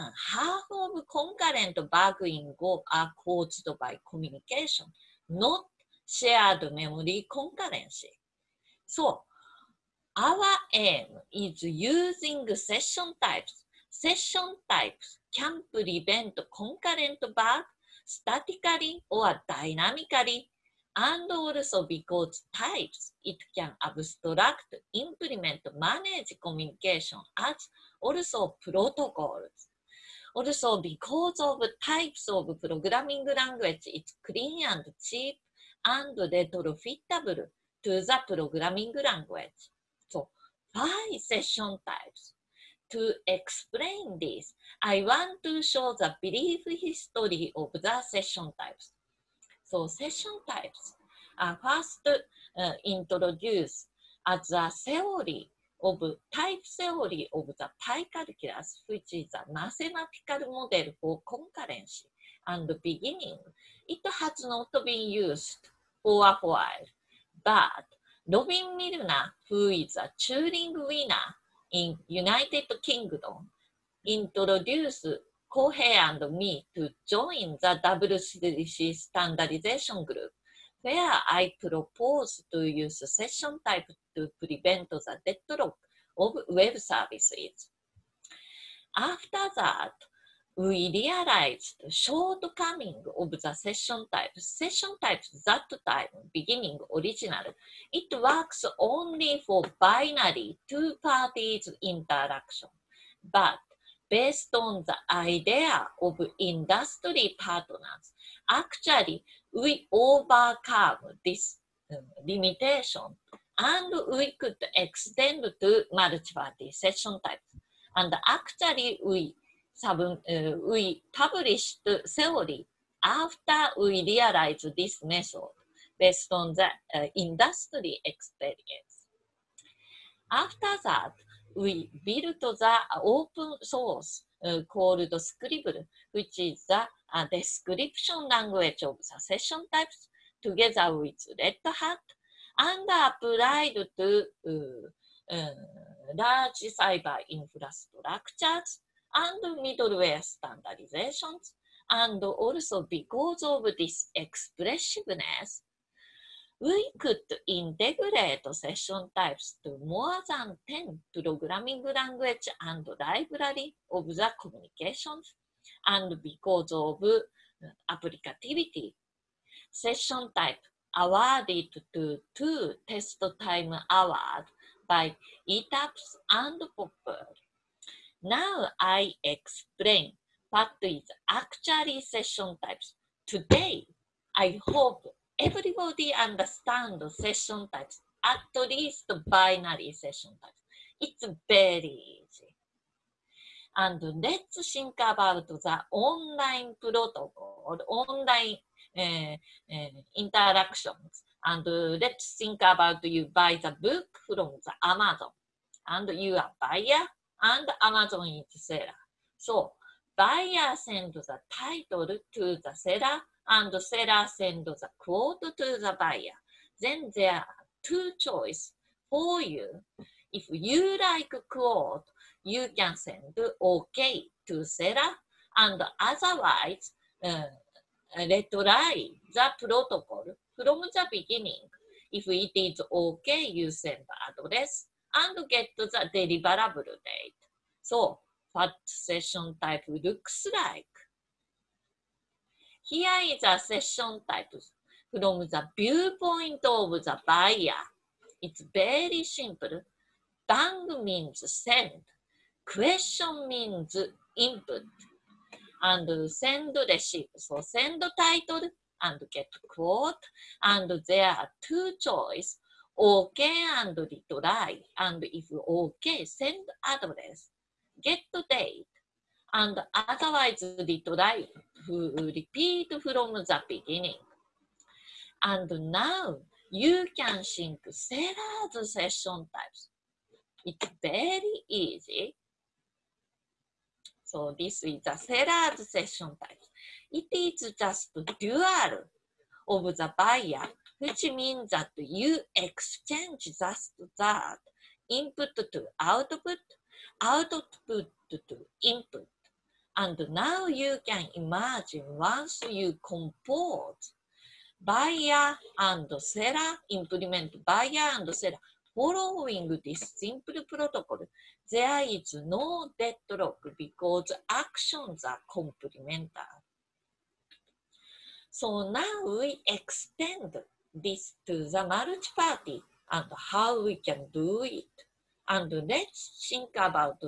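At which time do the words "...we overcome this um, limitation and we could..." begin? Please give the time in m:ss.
1:49.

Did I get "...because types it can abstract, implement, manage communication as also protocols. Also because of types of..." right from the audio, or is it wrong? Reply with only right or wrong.
right.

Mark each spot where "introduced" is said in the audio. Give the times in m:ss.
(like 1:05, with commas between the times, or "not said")
0:52, 1:14.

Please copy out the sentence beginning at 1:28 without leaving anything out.
After that, we realized shortcoming of the session type.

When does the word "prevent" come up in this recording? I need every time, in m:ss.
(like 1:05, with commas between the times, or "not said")
0:15, 1:24.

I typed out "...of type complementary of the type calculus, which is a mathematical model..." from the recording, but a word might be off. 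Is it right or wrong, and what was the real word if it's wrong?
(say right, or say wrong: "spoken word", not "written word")
wrong: "theory", not "complementary".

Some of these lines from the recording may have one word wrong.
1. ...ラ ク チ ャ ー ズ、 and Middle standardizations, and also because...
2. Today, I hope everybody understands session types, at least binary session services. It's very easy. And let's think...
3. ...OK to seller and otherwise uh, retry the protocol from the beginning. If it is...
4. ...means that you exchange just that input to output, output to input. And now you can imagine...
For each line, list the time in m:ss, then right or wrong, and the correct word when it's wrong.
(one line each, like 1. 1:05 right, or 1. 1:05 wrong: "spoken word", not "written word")
1. 2:28 right
2. 3:03 wrong: "types", not "services"
3. 3:43 right
4. 4:51 right.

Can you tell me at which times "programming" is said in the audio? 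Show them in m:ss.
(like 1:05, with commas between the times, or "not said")
0:32, 0:38, 2:41.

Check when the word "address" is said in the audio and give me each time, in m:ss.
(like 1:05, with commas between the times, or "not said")
3:54, 4:26.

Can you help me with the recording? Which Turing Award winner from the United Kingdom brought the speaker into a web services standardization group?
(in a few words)
Robin Milner.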